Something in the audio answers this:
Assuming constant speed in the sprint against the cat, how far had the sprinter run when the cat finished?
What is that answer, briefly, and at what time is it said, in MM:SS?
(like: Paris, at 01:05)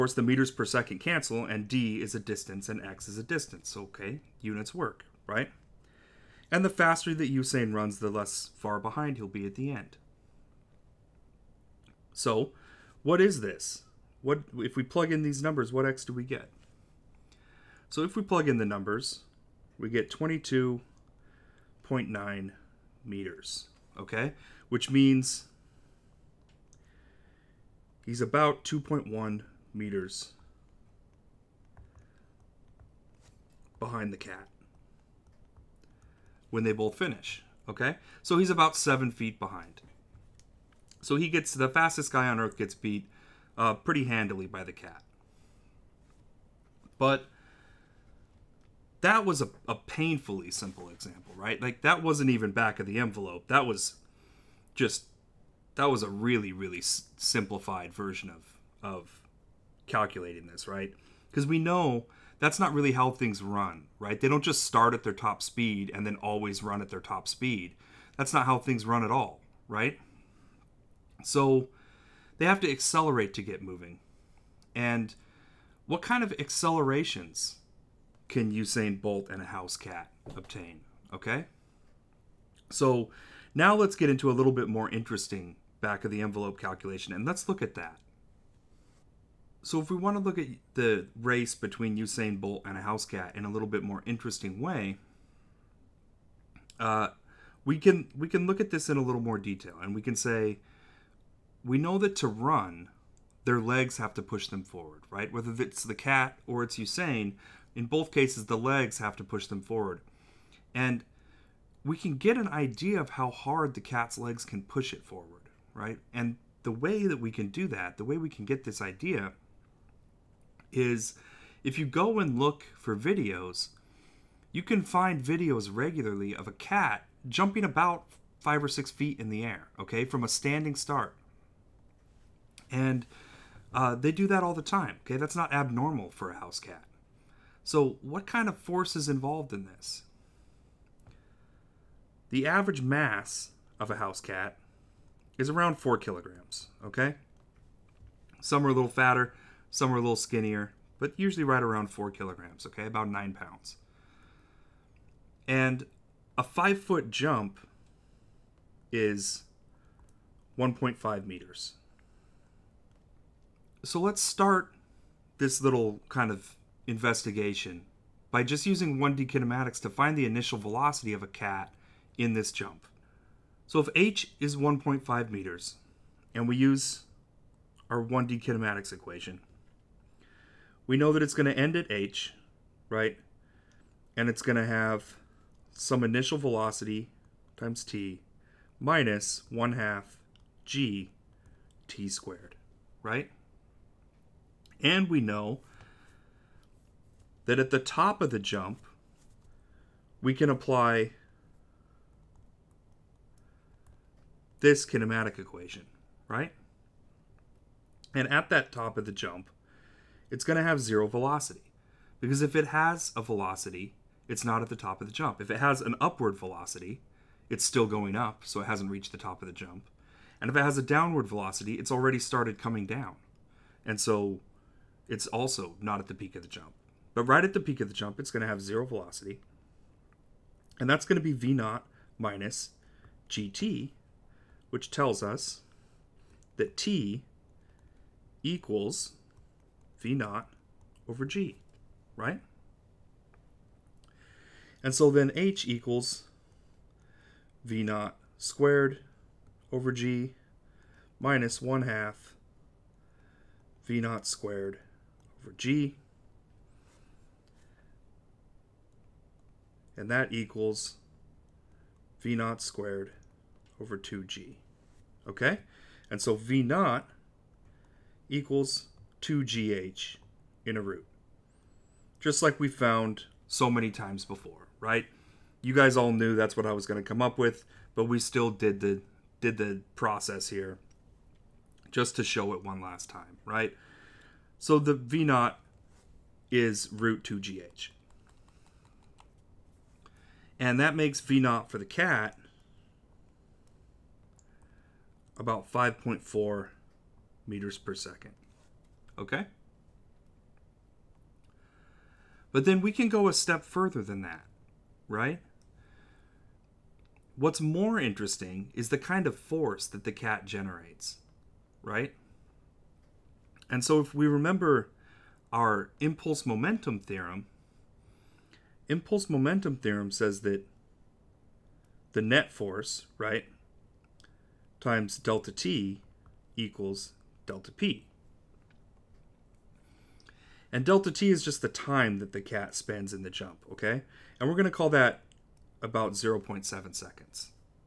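22.9 meters, at 00:20.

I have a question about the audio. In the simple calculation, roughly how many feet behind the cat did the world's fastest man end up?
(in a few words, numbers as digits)
7 feet.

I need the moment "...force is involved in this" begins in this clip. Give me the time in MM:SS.
02:18.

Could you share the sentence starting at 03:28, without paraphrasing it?
And at that top of the jump, it's going to have zero velocity.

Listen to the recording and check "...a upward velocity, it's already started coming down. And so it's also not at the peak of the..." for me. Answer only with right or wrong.
wrong.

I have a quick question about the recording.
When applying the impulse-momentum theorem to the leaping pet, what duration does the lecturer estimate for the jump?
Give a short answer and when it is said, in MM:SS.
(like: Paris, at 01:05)
0.7 seconds, at 05:36.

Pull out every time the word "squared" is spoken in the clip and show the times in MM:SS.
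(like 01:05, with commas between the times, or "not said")
03:12, 04:08, 04:14, 04:22.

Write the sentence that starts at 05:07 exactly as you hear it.
What's more interesting is the kind of force that the cat generates, right?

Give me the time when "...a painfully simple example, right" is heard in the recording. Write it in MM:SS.
00:49.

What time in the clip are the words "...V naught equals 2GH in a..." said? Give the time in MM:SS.
04:26.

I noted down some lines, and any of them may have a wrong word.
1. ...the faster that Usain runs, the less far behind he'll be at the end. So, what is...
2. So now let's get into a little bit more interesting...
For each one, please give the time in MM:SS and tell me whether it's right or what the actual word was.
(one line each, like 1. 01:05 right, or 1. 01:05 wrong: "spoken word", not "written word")
1. 00:06 right
2. 01:22 right.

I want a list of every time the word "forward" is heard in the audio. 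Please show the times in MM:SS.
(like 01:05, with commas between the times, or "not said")
01:44, 01:49, 01:55.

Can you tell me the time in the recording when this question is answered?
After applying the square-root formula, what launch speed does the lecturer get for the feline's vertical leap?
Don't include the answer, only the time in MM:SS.
04:55.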